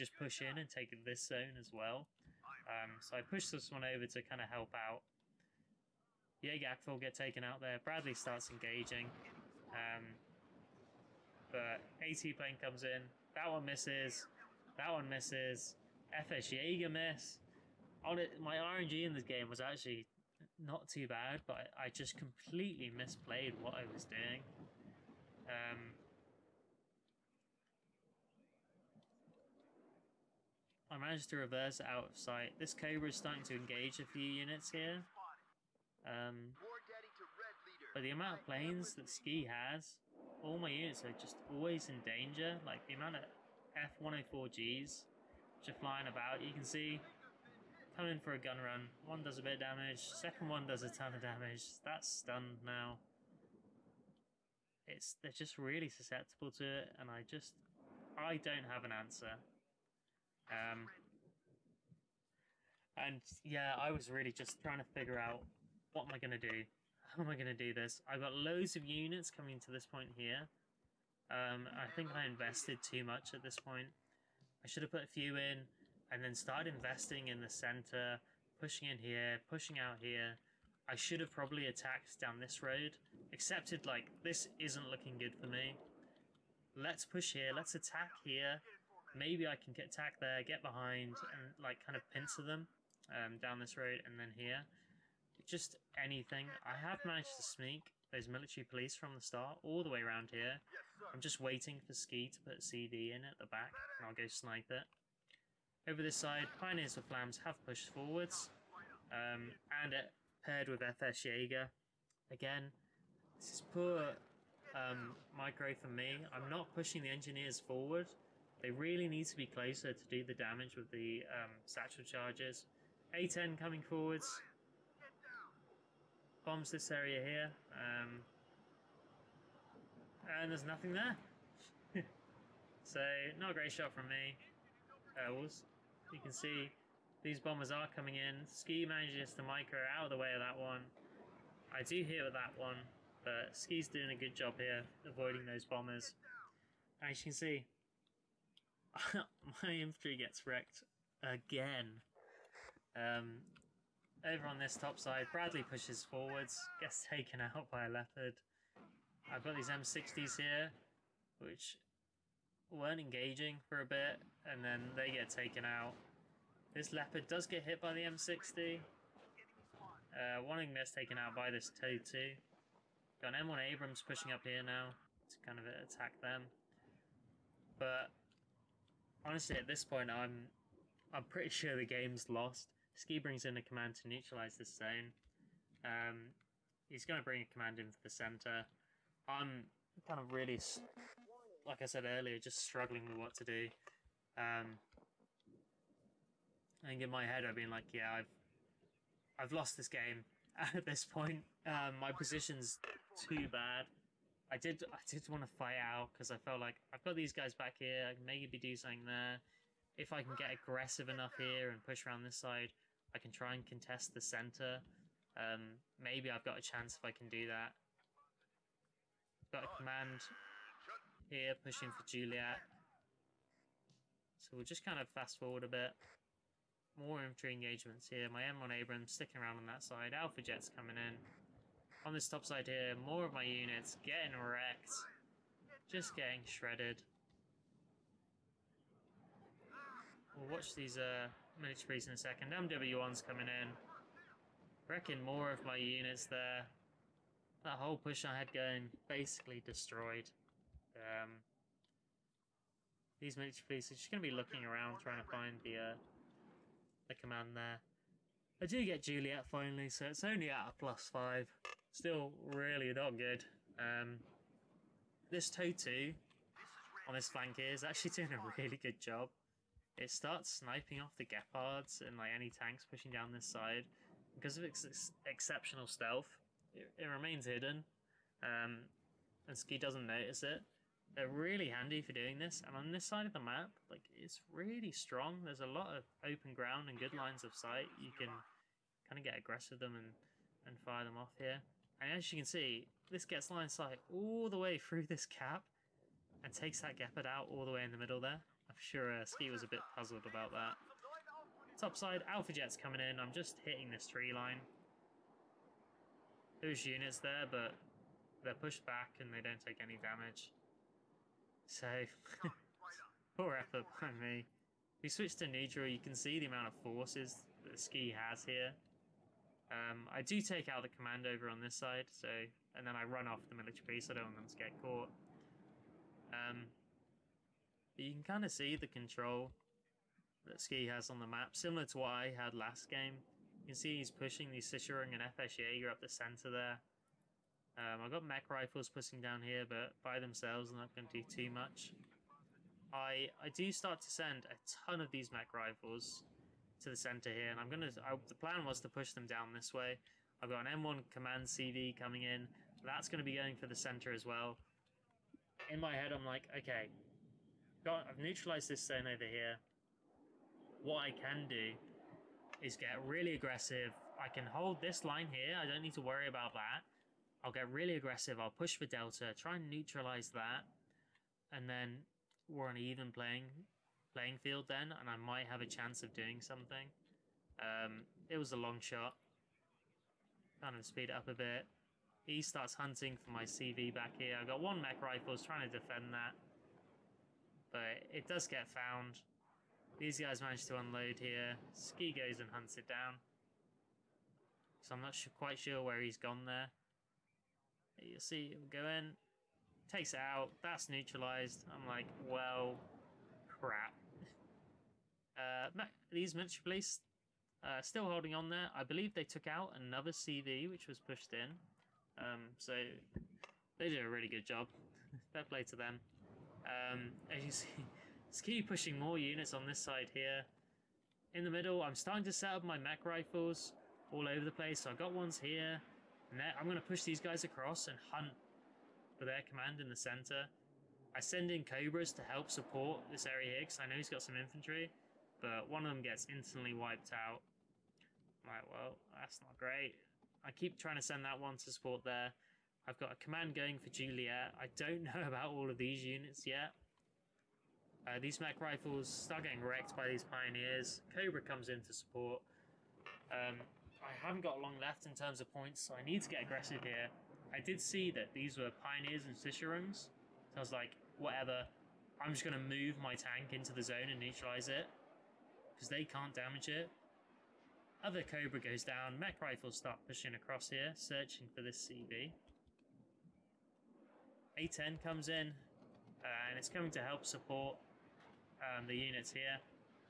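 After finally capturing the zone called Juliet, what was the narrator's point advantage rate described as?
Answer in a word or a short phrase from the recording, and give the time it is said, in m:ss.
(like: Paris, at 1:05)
Plus 5, at 4:20.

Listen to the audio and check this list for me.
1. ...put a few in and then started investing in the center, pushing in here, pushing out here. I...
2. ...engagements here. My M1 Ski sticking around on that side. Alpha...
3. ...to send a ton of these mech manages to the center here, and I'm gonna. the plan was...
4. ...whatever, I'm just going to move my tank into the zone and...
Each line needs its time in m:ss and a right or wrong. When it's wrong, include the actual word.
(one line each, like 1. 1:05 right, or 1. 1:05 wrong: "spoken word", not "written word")
1. 1:14 right
2. 3:47 wrong: "Abrams", not "Ski"
3. 5:44 wrong: "rifles", not "manages"
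4. 7:41 right.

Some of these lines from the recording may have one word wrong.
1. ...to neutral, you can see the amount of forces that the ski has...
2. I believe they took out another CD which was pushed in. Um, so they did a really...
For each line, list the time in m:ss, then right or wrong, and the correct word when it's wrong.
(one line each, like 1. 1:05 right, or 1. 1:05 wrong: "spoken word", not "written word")
1. 5:15 right
2. 6:48 right.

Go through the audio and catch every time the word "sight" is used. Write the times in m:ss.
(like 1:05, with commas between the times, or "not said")
0:32, 4:47, 4:53.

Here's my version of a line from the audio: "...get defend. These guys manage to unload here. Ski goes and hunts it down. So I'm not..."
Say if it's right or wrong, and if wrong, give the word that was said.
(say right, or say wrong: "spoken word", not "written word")
wrong: "found", not "defend".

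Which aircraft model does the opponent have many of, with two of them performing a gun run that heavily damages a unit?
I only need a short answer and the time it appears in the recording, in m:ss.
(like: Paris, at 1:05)
F-104G, at 0:44.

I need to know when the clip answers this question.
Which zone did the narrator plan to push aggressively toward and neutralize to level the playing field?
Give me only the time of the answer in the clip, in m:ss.
6:08.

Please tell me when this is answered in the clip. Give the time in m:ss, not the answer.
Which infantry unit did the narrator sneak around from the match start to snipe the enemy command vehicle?
1:38.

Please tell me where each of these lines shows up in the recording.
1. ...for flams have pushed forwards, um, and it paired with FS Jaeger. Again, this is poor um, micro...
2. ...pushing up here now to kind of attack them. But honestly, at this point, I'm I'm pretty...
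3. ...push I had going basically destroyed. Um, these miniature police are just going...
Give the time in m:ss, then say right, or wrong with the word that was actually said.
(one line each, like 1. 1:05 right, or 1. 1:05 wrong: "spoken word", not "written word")
1. 1:46 right
2. 2:54 right
3. 4:07 right.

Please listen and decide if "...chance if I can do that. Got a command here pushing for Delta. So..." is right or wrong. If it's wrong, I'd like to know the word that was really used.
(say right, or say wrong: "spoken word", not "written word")
wrong: "Juliet", not "Delta".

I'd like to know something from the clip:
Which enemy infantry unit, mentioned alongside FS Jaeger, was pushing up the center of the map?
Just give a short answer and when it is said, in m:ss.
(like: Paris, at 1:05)
Sicherung, at 5:34.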